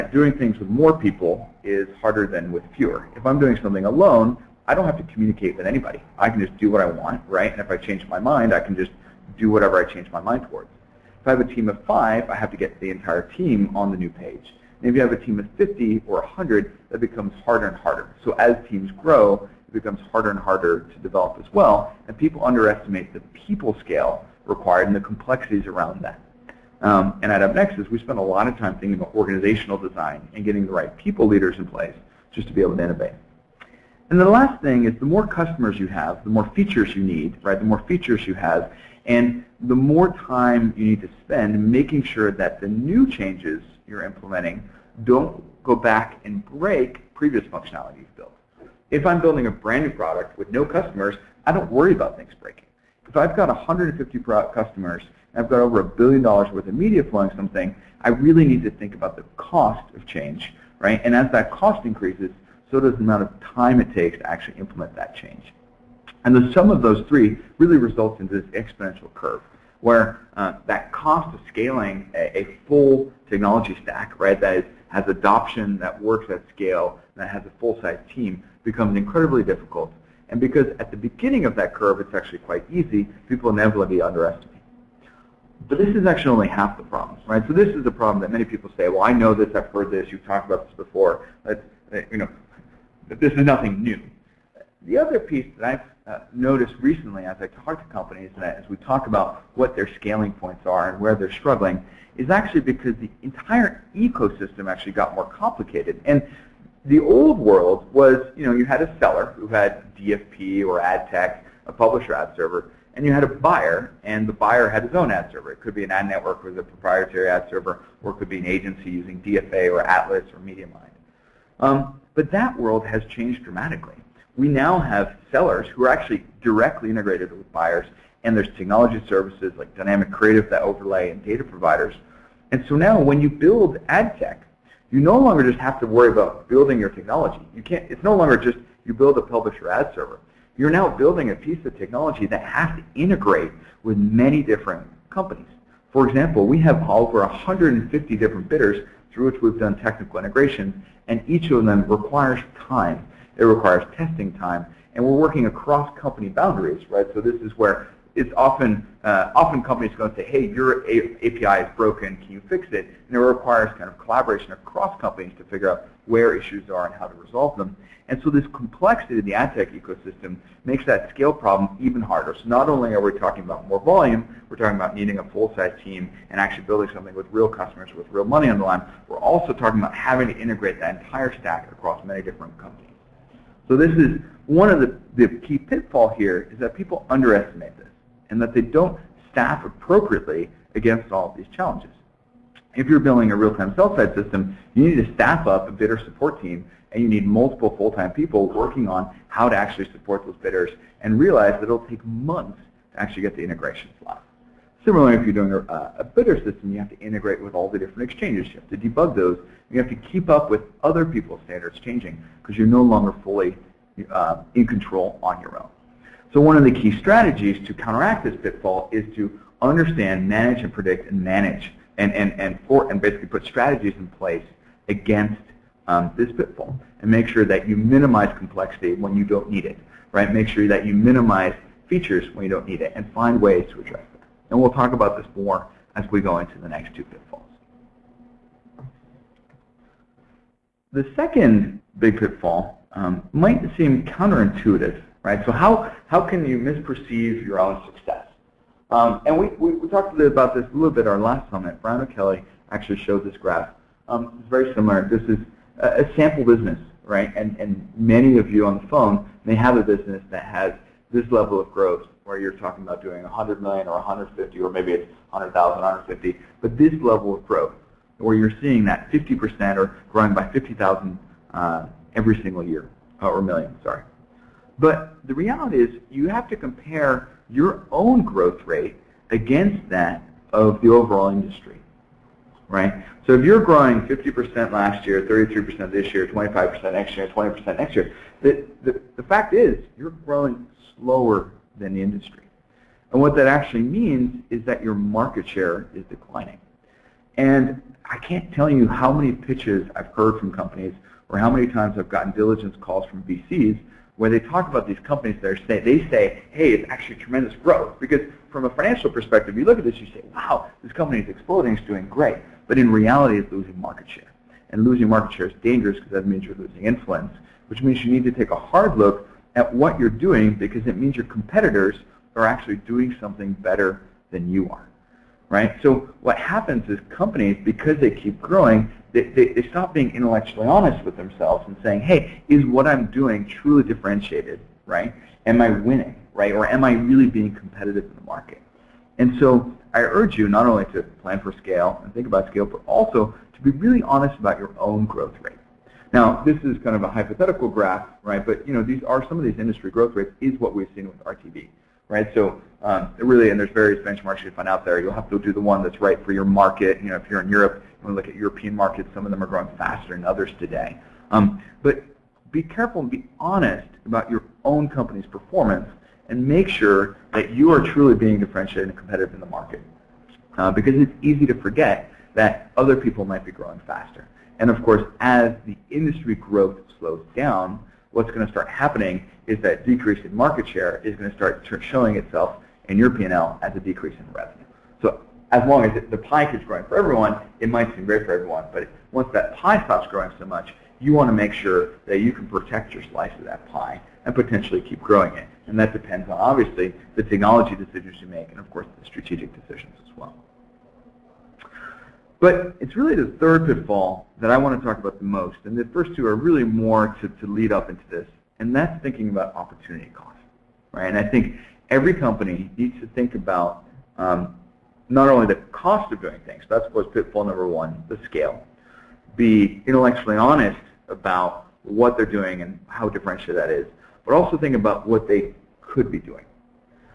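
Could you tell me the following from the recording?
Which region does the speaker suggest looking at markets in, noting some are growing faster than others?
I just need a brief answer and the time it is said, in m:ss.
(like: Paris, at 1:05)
Europe, at 5:57.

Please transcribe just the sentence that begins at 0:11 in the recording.
If I have a team of five, I have to get the entire team on the new page.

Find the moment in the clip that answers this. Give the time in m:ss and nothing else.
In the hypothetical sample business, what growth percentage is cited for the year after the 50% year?
4:45.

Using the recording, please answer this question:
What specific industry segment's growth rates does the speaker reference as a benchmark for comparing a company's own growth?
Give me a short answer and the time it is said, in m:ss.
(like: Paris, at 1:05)
RTB, at 5:51.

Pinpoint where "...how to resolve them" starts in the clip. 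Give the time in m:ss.
2:46.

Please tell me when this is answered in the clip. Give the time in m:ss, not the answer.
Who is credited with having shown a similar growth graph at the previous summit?
4:11.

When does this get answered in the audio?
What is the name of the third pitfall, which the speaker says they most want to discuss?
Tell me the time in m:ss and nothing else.
6:49.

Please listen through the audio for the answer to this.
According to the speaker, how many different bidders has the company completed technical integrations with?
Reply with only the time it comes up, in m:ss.
2:26.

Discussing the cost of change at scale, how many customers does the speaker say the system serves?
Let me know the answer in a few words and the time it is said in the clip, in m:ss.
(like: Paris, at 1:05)
150, at 0:53.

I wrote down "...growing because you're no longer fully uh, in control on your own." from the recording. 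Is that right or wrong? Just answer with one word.
wrong.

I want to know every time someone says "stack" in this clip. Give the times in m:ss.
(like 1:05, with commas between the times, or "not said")
1:13, 3:01.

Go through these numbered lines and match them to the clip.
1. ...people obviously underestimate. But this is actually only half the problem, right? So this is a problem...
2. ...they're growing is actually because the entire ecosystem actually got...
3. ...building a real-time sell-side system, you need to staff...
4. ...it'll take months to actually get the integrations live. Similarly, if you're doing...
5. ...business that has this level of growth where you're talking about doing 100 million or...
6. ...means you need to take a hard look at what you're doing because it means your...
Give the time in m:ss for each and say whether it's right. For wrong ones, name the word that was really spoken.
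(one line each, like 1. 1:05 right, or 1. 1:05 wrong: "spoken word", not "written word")
1. 1:23 wrong: "inevitably", not "obviously"
2. 1:41 wrong: "struggling", not "growing"
3. 3:12 right
4. 3:21 right
5. 4:19 right
6. 5:17 right.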